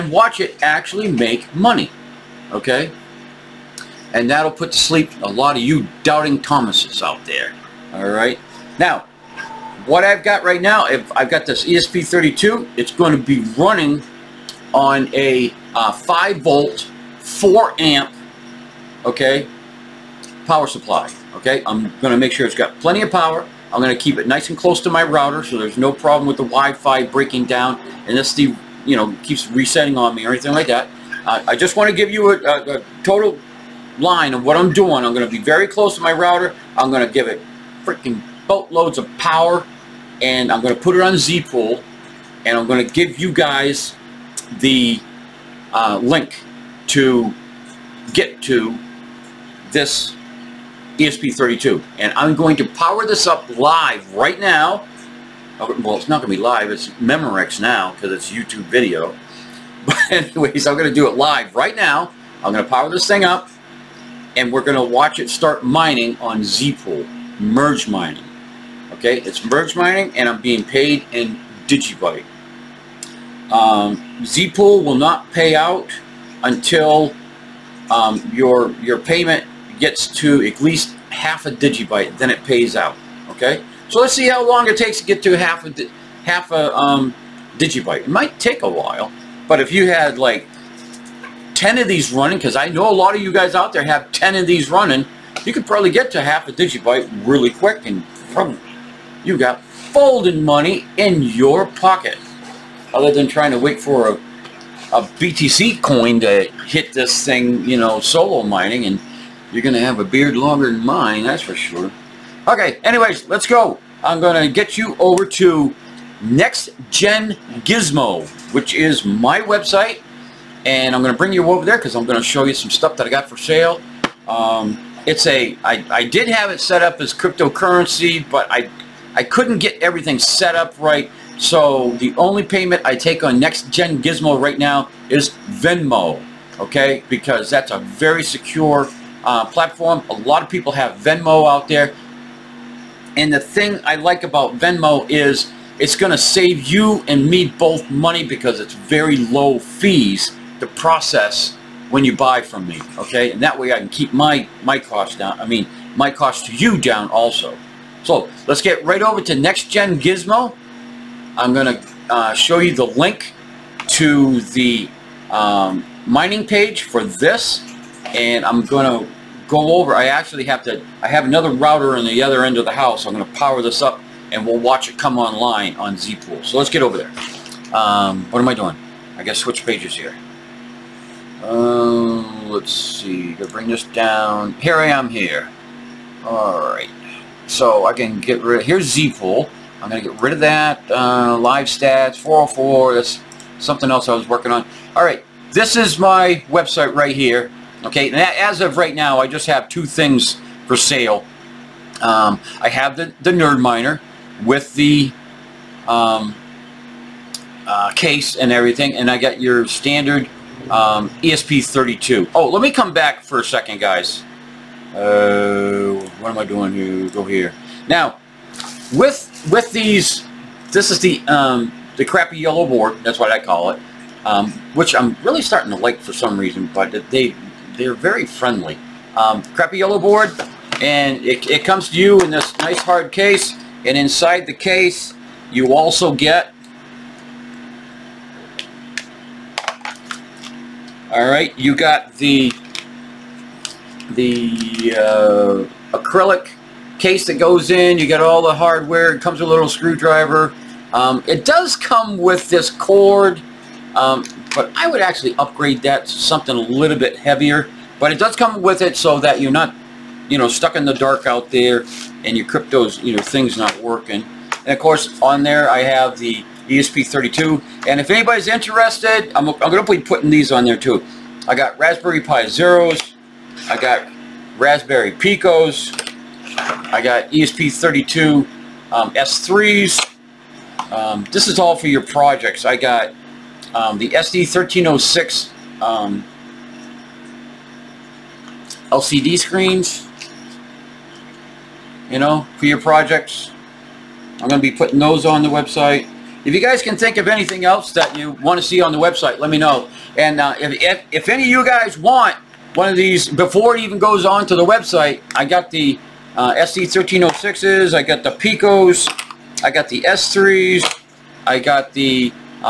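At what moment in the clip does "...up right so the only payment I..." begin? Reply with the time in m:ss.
2:10.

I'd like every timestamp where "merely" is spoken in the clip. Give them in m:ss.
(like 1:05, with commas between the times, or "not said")
not said.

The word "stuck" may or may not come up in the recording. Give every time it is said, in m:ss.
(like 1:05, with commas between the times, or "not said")
4:20.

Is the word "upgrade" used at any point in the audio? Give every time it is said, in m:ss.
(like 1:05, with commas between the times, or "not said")
4:15.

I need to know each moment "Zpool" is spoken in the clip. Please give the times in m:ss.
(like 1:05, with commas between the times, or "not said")
0:41, 1:06, 1:14, 2:55, 3:08.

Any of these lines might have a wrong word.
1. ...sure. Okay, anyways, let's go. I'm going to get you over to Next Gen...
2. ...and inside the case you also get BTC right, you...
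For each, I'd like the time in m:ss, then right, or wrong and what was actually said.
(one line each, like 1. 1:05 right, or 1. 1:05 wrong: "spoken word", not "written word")
1. 1:51 right
2. 3:53 wrong: "All", not "BTC".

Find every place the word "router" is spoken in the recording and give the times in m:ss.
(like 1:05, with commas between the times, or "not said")
0:25, 0:36, 2:51.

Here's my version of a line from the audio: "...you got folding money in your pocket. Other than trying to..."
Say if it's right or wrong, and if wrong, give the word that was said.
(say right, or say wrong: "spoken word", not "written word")
right.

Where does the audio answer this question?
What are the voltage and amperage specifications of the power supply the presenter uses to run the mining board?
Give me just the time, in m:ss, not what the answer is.
0:15.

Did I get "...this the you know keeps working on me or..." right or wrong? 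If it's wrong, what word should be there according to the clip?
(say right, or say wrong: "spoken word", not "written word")
wrong: "resetting", not "working".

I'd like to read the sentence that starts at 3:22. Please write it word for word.
Um, I have the, the Nerd Miner with the um, uh, case and everything, and I got your standard um, ESP32.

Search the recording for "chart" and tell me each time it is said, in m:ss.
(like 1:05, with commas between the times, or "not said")
not said.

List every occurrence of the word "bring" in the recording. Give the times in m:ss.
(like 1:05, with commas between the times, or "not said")
2:01, 3:03.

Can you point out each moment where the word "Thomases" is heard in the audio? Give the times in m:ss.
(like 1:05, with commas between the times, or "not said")
0:06.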